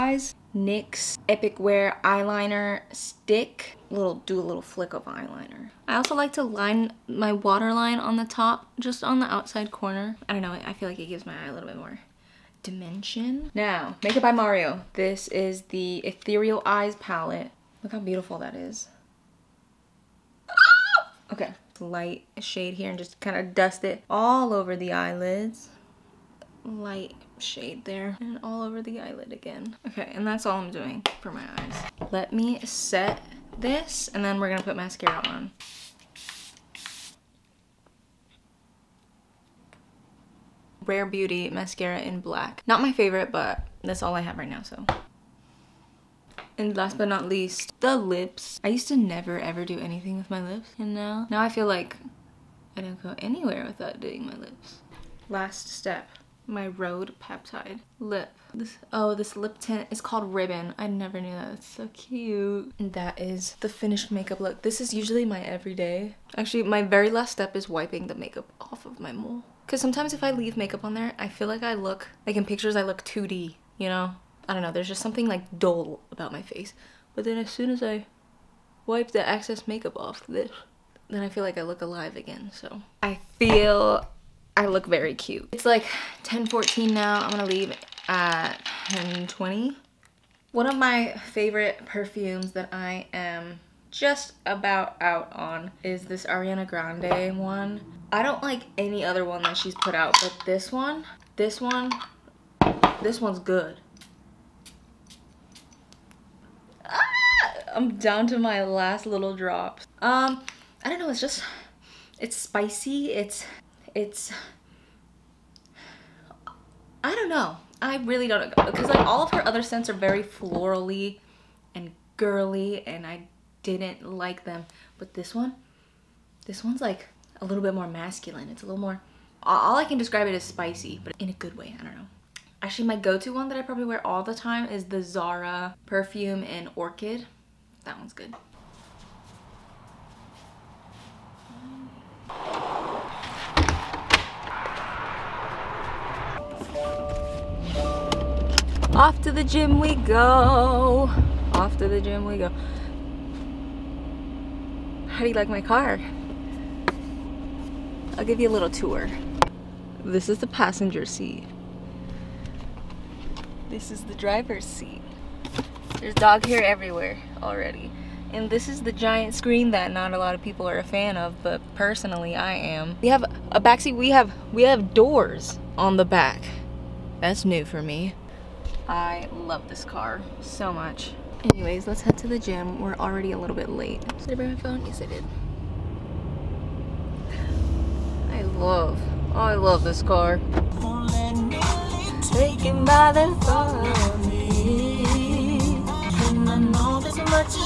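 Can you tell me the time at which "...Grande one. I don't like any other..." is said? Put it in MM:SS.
01:36.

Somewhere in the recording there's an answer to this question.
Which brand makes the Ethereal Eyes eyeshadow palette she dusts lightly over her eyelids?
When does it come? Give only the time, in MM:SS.
00:14.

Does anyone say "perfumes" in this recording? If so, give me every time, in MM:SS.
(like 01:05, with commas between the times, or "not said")
01:31, 02:15.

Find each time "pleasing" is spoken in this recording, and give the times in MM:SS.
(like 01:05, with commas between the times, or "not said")
not said.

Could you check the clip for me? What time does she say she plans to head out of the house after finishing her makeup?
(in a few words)
10:20.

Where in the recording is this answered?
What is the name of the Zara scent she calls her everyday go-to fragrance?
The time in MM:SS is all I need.
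02:16.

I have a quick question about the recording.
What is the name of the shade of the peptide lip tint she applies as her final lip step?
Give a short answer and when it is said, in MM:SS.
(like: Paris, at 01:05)
Ribbon, at 01:00.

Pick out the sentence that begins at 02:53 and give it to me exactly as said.
We have a backseat, we have we have doors on the back.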